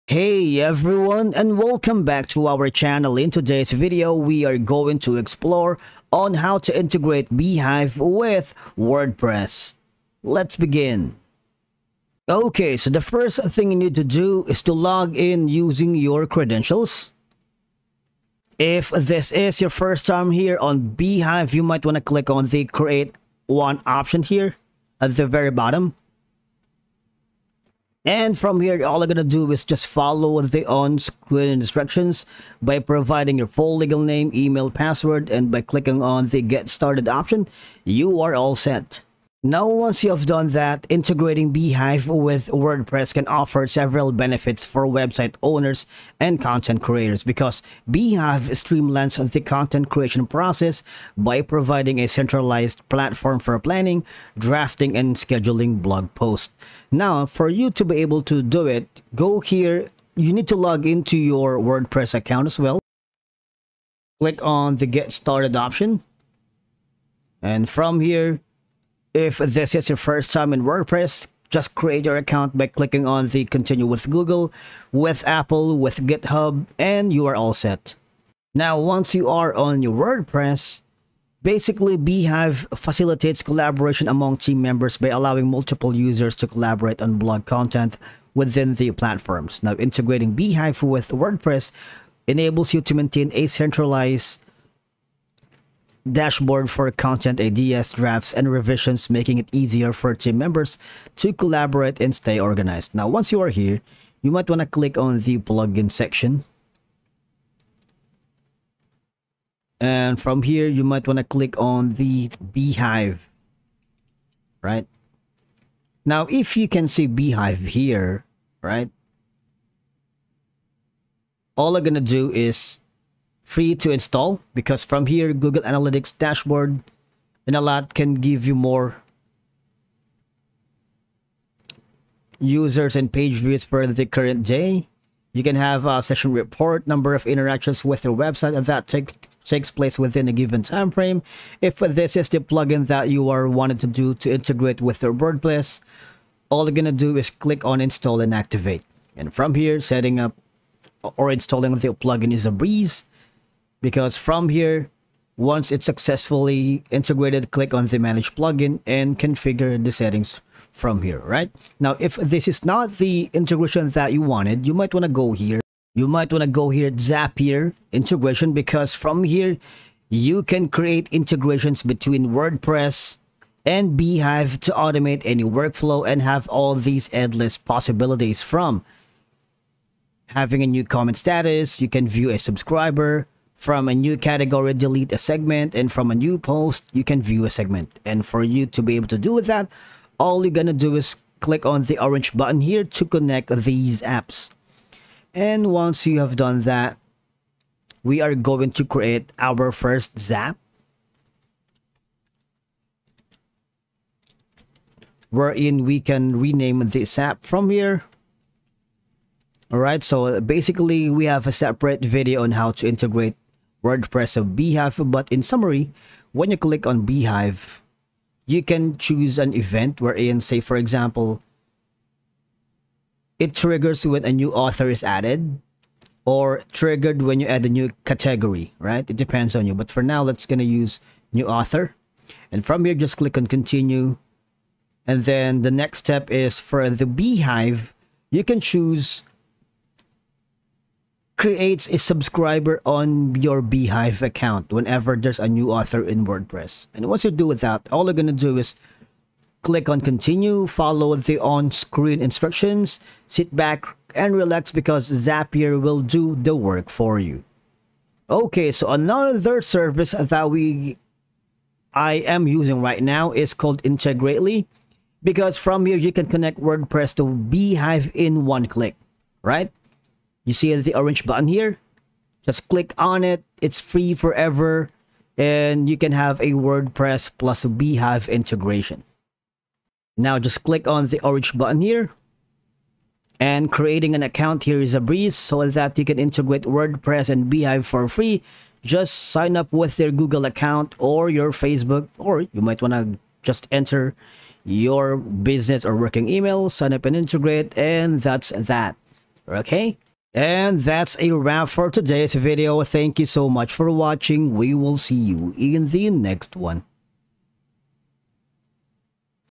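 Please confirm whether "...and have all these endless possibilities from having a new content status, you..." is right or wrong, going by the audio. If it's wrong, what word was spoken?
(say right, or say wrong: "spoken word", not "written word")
wrong: "comment", not "content".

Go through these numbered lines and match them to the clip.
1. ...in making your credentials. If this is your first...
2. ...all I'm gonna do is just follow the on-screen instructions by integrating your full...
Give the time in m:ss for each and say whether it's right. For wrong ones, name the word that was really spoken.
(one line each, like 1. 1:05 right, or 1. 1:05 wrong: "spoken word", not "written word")
1. 0:15 wrong: "using", not "making"
2. 0:28 wrong: "providing", not "integrating".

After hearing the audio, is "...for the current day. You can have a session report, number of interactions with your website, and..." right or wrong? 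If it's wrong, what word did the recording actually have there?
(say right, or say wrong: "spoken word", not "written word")
right.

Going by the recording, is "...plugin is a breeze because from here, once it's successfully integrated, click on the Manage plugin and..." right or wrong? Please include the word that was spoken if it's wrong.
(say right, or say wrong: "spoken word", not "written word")
right.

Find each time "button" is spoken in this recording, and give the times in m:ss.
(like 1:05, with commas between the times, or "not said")
3:12, 4:31, 4:41.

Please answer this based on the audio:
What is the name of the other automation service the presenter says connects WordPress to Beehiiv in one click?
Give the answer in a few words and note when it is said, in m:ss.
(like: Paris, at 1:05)
Integrately, at 4:23.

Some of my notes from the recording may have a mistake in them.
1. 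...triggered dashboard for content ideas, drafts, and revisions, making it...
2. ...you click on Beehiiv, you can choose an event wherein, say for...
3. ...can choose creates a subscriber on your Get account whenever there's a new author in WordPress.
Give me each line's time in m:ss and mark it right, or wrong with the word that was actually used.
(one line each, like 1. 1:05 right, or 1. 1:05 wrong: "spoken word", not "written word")
1. 1:33 wrong: "centralized", not "triggered"
2. 3:36 right
3. 3:58 wrong: "Beehiiv", not "Get".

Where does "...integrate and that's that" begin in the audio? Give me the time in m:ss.
4:57.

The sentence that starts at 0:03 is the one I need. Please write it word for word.
In today's video, we are going to explore on how to integrate Beehiiv with WordPress.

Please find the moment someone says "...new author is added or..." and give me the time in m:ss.
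3:44.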